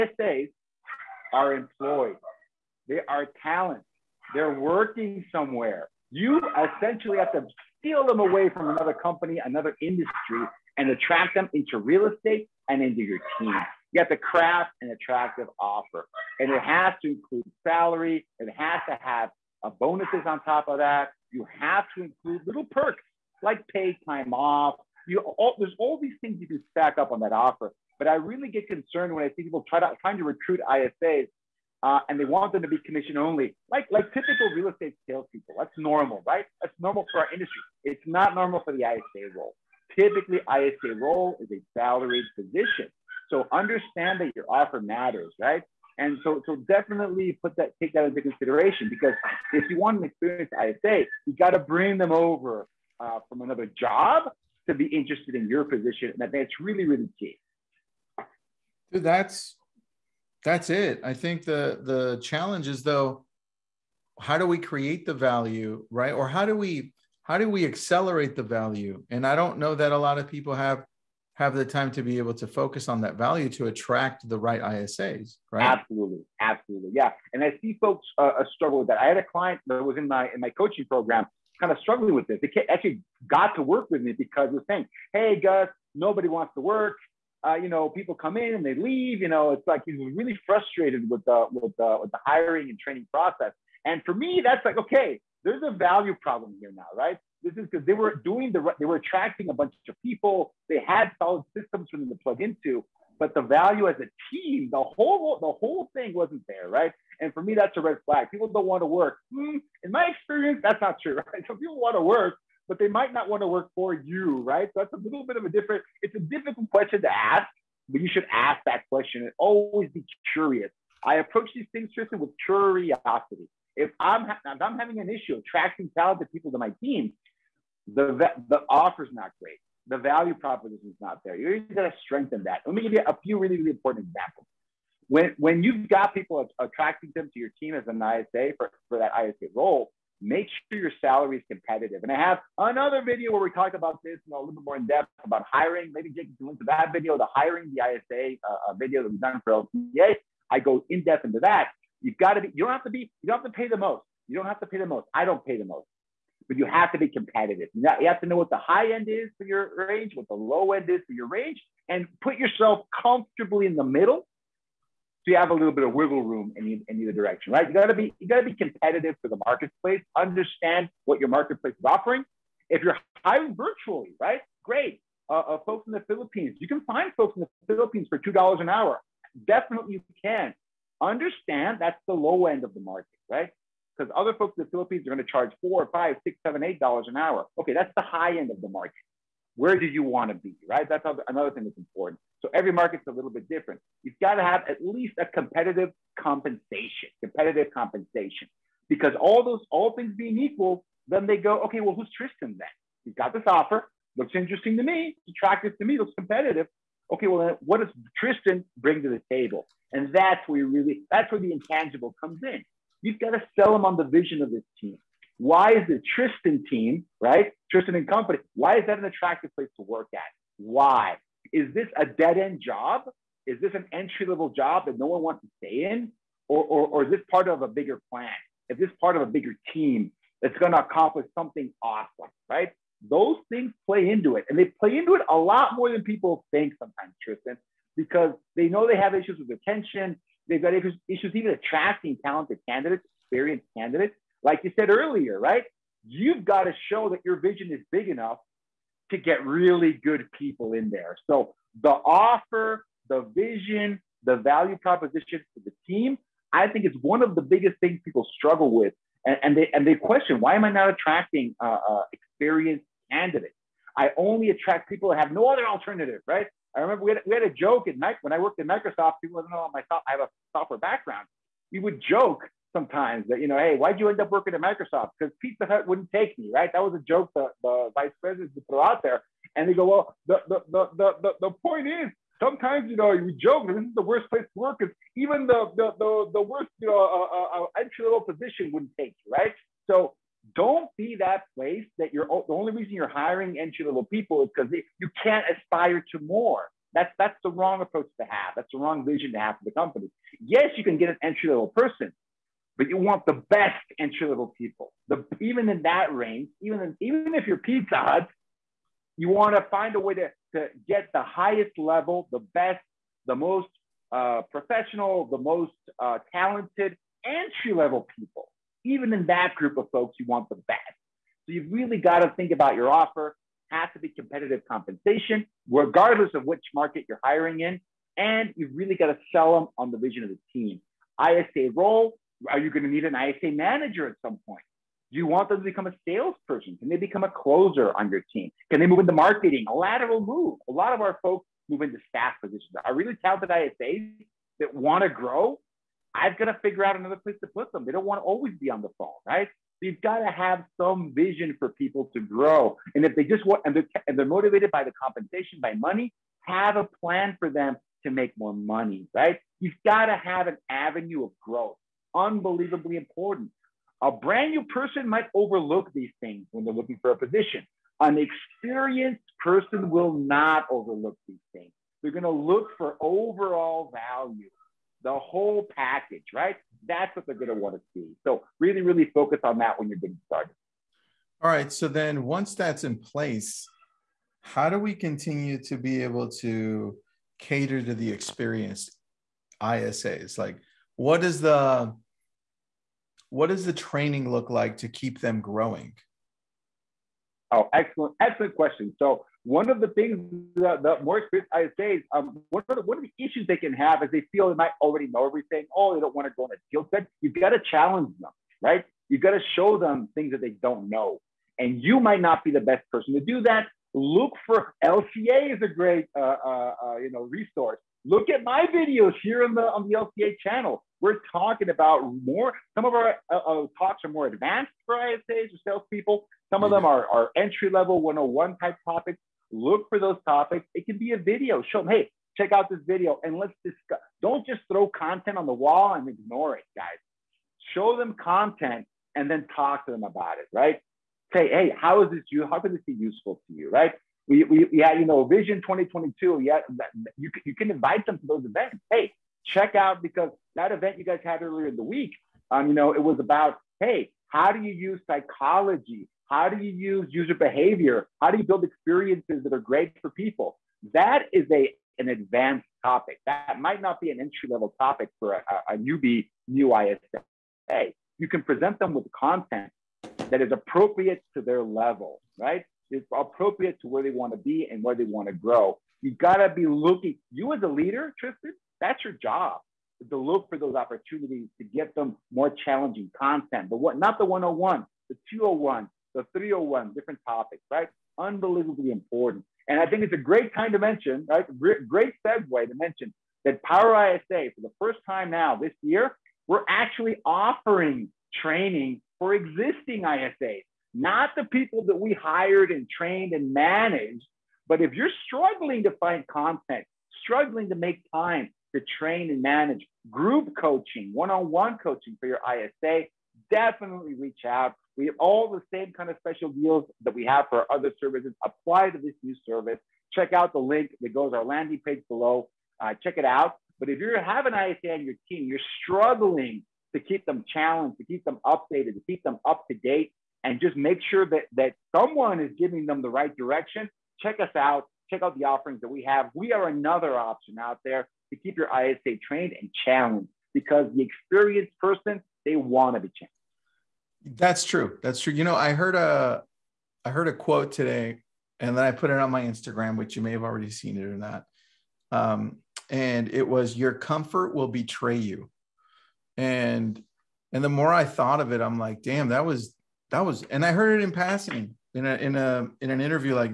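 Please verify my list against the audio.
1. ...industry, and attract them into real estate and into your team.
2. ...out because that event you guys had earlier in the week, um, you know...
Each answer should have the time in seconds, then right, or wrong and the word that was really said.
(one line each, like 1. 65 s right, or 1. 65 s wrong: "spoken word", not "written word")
1. 9 s right
2. 449 s right.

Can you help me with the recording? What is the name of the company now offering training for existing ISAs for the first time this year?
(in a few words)
Power ISA.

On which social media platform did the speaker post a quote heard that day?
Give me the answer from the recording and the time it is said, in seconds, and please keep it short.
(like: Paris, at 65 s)
Instagram, at 549 s.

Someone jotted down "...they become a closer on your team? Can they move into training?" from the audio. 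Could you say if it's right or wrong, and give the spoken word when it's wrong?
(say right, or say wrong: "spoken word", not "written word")
wrong: "marketing", not "training".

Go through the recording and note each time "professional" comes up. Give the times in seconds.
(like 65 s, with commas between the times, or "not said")
314 s.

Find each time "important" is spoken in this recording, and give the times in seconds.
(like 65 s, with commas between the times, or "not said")
133 s, 191 s, 362 s, 488 s.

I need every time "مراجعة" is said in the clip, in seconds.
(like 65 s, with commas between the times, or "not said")
not said.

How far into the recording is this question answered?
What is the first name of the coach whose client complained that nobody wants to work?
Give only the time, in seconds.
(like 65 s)
85 s.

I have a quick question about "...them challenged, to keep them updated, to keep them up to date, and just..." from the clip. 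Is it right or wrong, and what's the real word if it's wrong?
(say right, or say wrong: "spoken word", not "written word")
right.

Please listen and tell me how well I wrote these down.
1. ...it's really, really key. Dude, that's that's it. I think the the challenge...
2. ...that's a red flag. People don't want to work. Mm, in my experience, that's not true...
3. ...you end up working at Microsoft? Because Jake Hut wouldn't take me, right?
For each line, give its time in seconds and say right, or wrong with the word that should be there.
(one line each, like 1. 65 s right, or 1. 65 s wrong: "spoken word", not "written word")
1. 56 s right
2. 107 s right
3. 273 s wrong: "Pizza", not "Jake".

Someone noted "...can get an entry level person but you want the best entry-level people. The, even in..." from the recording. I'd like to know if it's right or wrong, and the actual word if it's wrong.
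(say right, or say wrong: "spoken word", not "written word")
right.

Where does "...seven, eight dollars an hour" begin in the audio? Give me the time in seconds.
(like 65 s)
186 s.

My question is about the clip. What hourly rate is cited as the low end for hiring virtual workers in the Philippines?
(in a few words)
$2 an hour.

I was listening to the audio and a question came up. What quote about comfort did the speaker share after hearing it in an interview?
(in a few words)
Your comfort will betray you.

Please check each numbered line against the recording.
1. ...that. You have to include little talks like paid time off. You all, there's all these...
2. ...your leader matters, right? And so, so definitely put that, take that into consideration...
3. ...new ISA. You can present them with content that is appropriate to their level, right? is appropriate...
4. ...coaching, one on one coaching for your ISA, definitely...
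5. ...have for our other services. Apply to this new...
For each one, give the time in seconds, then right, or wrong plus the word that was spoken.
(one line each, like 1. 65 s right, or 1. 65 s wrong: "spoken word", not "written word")
1. 20 s wrong: "perks", not "talks"
2. 44 s wrong: "offer", not "leader"
3. 466 s right
4. 510 s right
5. 517 s right.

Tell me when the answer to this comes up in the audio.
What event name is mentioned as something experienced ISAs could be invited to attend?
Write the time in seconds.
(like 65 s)
445 s.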